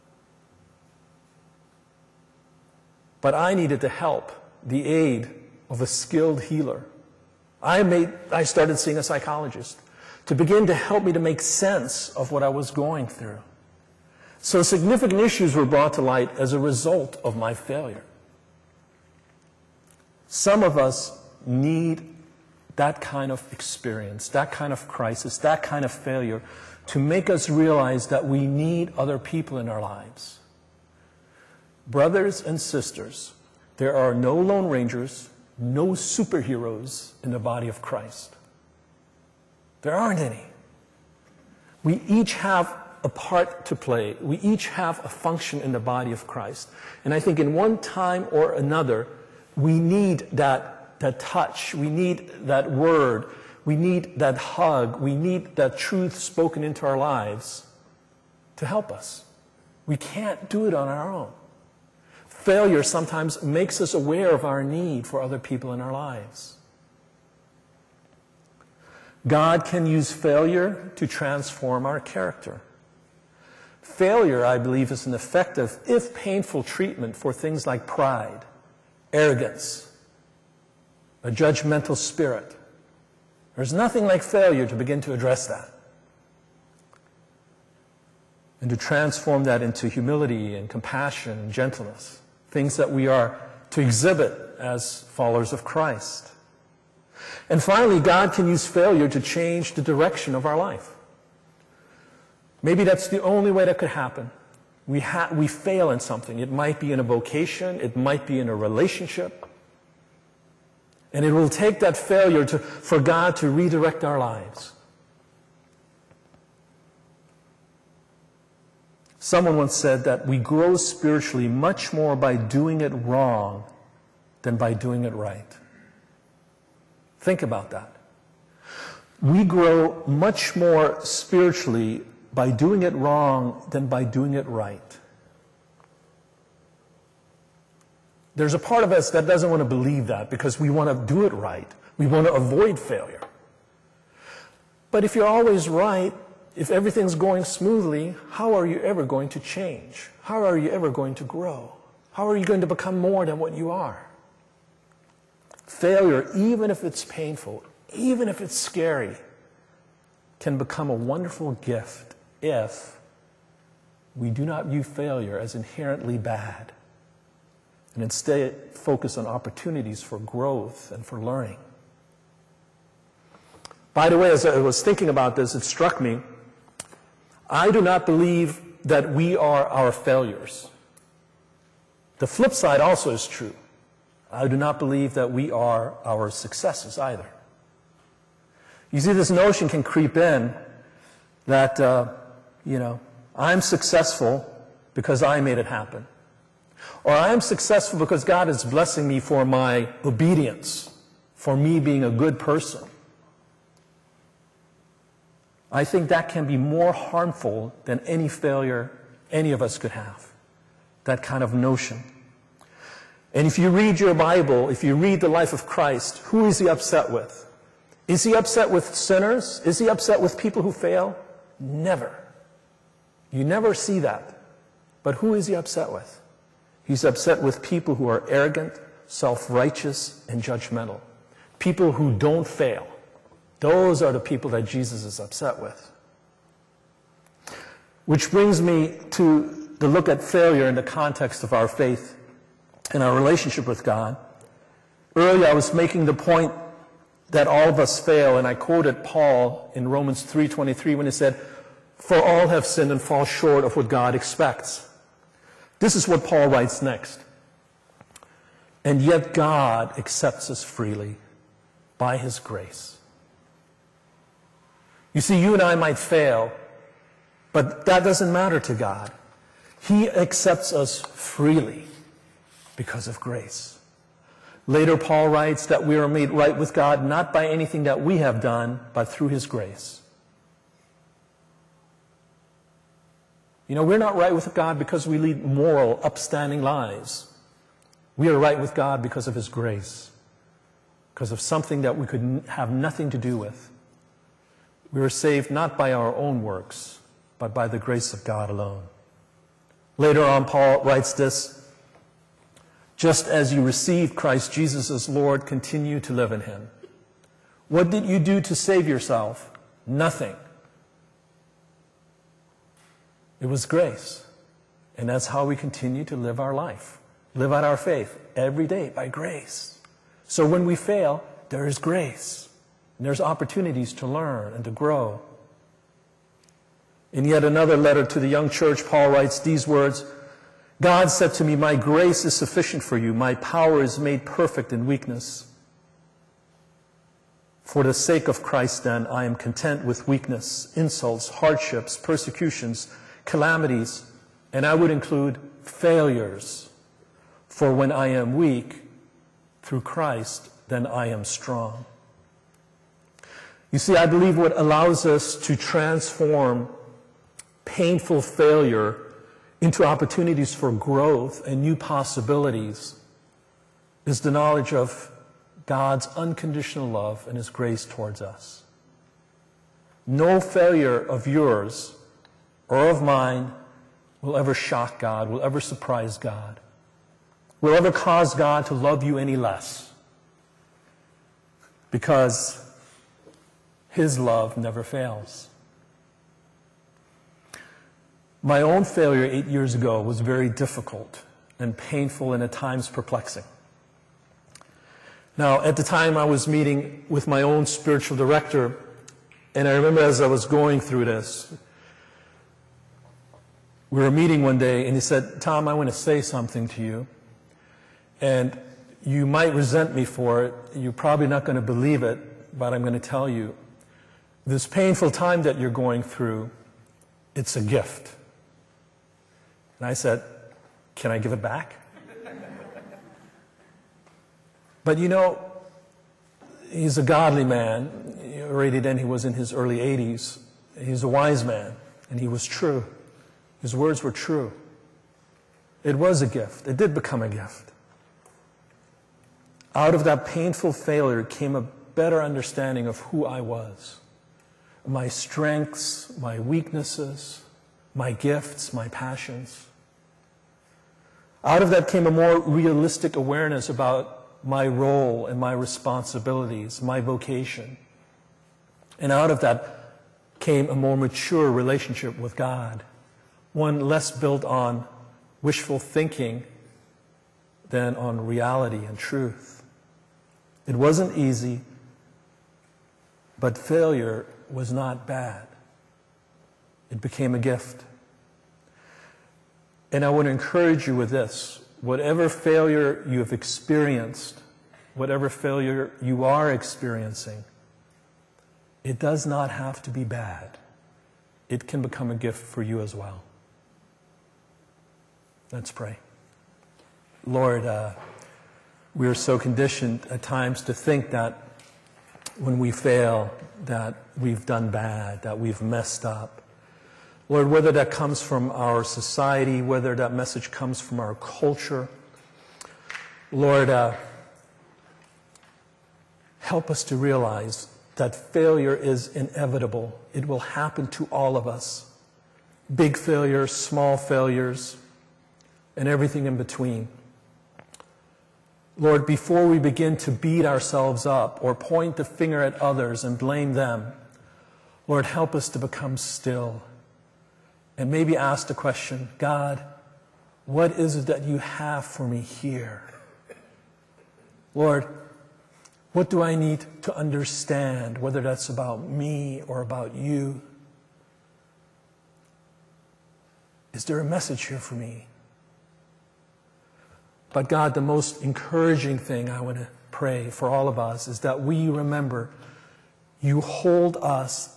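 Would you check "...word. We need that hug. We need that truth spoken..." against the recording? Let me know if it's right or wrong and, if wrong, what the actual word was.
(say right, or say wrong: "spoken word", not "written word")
right.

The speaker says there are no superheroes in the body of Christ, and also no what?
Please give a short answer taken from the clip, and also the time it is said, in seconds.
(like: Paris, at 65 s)
Lone Rangers, at 34 s.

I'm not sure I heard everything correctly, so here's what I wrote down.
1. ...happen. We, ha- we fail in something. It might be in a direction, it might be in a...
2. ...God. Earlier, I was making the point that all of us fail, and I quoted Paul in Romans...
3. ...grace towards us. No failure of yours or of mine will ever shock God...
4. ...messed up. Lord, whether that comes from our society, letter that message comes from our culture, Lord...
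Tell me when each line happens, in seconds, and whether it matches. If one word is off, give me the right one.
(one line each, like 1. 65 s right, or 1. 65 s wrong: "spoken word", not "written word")
1. 103 s wrong: "vocation", not "direction"
2. 243 s right
3. 367 s right
4. 505 s wrong: "whether", not "letter".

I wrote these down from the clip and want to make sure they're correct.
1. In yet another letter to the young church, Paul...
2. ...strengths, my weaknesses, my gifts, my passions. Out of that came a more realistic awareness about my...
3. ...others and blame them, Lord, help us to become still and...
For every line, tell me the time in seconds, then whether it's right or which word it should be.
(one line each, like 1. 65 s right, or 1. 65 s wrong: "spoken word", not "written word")
1. 327 s right
2. 445 s right
3. 532 s right.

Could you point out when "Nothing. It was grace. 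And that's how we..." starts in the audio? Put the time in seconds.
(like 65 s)
309 s.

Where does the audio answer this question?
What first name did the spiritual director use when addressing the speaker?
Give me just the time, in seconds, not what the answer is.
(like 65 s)
405 s.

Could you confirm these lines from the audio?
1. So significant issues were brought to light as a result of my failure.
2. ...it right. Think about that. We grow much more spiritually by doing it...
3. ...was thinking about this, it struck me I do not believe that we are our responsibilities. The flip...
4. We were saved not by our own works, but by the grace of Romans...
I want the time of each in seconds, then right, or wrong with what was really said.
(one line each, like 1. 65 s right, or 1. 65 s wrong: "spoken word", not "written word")
1. 14 s right
2. 125 s right
3. 174 s wrong: "failures", not "responsibilities"
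4. 294 s wrong: "God", not "Romans".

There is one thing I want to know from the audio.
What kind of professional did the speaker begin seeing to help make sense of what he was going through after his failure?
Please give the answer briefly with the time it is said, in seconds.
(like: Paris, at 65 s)
Psychologist, at 9 s.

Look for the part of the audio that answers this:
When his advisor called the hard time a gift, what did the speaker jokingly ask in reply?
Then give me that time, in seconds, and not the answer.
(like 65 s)
420 s.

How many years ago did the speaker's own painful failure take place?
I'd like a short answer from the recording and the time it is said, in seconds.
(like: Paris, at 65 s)
8, at 389 s.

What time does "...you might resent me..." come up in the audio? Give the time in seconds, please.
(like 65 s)
409 s.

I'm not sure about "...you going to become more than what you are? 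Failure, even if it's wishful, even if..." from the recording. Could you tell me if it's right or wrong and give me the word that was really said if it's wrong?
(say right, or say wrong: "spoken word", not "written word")
wrong: "painful", not "wishful".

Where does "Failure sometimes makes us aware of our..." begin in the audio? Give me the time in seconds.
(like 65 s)
62 s.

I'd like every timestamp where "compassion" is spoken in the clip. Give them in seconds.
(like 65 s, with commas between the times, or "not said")
90 s.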